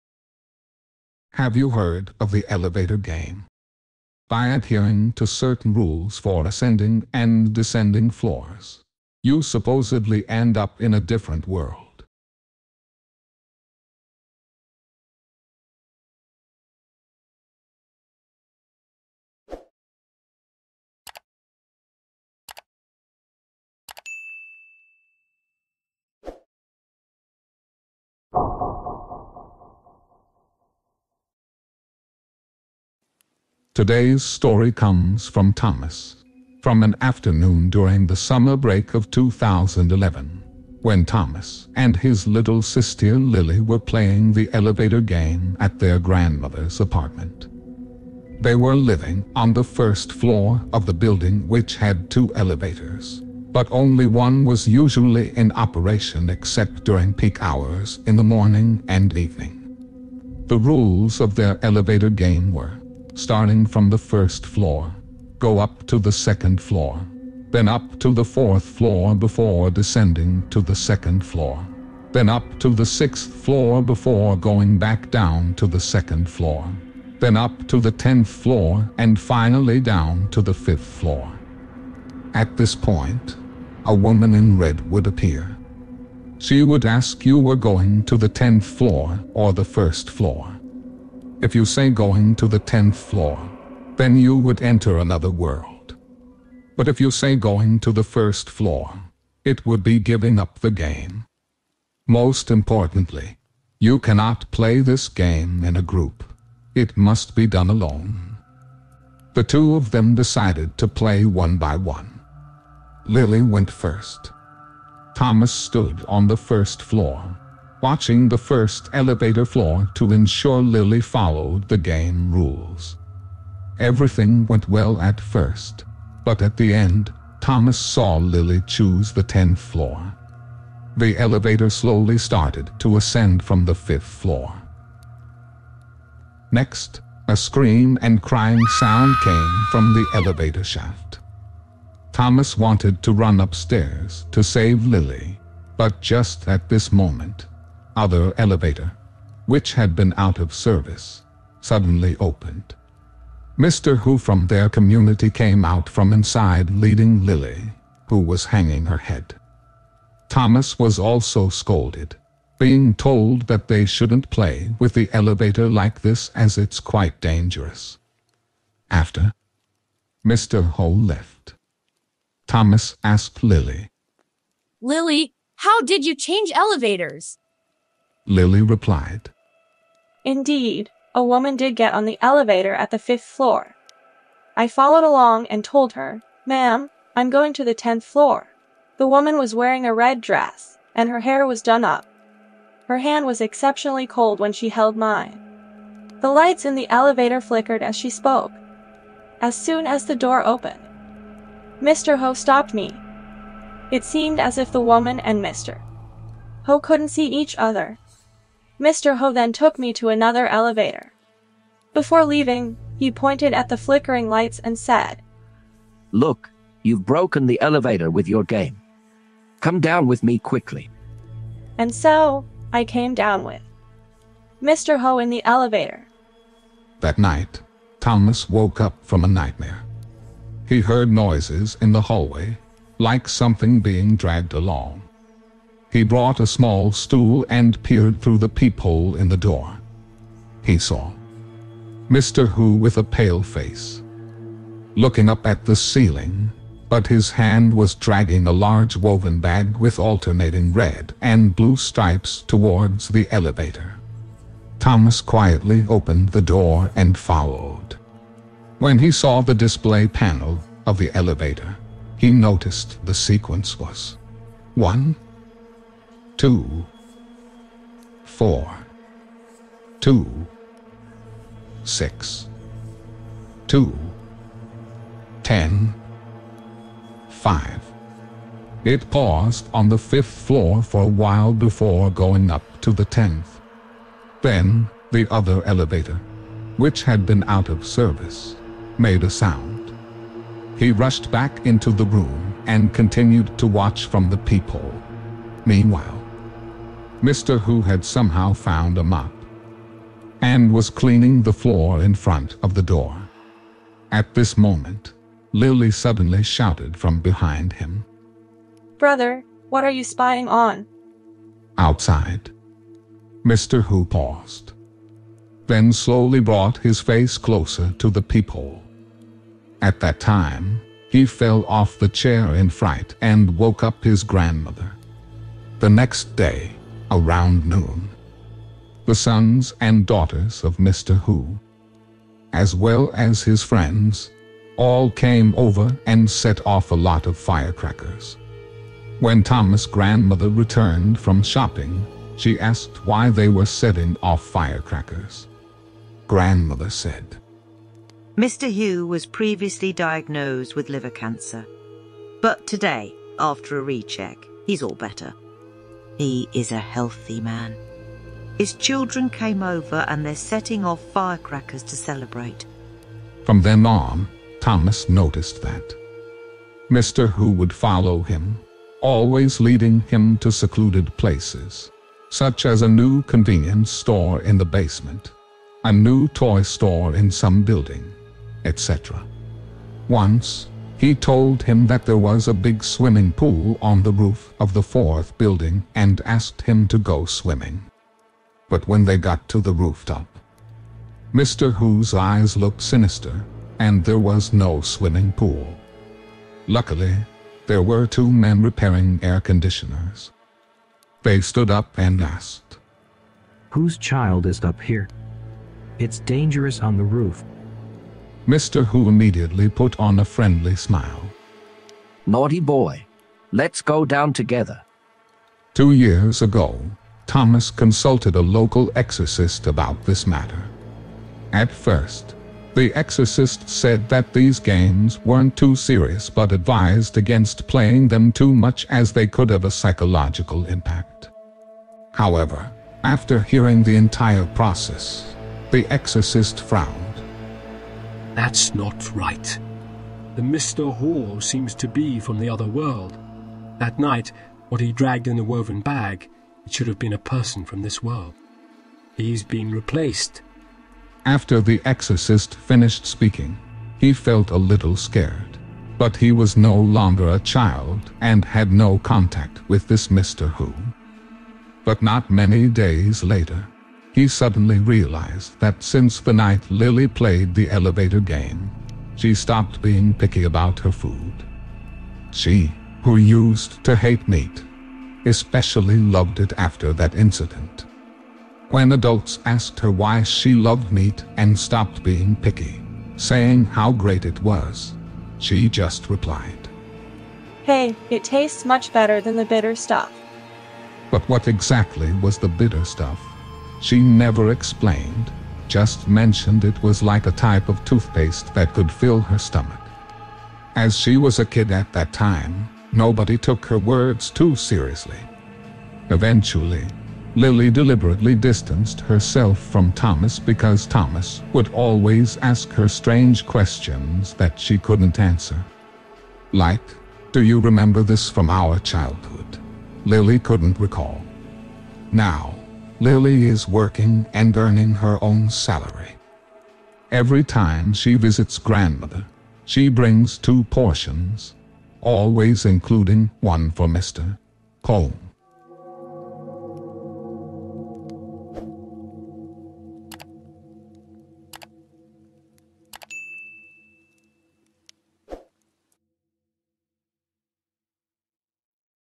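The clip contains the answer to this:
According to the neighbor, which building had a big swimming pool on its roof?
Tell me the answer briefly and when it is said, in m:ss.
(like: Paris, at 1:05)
Fourth building, at 6:24.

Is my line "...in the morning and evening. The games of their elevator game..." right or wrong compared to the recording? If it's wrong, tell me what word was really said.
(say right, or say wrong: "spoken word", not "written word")
wrong: "rules", not "games".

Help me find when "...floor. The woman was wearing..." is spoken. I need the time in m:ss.
3:08.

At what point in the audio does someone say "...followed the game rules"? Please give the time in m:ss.
2:01.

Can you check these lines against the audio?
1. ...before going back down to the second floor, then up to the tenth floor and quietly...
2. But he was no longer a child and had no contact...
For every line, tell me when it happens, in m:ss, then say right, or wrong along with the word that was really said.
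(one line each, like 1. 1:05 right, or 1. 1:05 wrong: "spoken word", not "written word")
1. 1:13 wrong: "finally", not "quietly"
2. 7:35 right.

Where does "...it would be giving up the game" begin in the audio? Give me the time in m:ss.
1:39.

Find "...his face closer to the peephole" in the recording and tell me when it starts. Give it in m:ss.
5:16.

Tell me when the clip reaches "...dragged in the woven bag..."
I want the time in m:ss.
7:24.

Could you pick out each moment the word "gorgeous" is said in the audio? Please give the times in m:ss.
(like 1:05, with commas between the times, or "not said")
not said.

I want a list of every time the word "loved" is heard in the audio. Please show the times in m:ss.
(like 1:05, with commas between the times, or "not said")
7:55, 8:00.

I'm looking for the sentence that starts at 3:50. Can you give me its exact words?
He heard noises in the hallway, like something being dragged along.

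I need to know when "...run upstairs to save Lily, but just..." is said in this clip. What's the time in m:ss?
2:23.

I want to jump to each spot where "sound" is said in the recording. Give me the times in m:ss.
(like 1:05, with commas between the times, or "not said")
2:18, 4:49.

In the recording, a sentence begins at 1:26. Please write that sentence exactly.
She would ask you were going to the 10th floor or the first floor.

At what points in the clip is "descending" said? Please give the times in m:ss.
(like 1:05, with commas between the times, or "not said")
0:07, 1:09.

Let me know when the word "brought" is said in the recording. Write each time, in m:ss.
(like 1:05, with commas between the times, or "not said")
3:56, 5:16.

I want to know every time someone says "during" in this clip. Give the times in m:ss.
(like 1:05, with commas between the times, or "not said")
0:37, 0:56.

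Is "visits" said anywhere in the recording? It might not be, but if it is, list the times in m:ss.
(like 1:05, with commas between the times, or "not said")
8:48.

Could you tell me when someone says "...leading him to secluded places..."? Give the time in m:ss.
6:09.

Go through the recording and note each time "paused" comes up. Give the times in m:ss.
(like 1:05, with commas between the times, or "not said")
4:39, 5:14.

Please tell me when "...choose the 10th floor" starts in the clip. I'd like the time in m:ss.
2:08.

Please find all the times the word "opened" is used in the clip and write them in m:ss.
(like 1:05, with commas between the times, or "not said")
2:32, 3:20, 4:15.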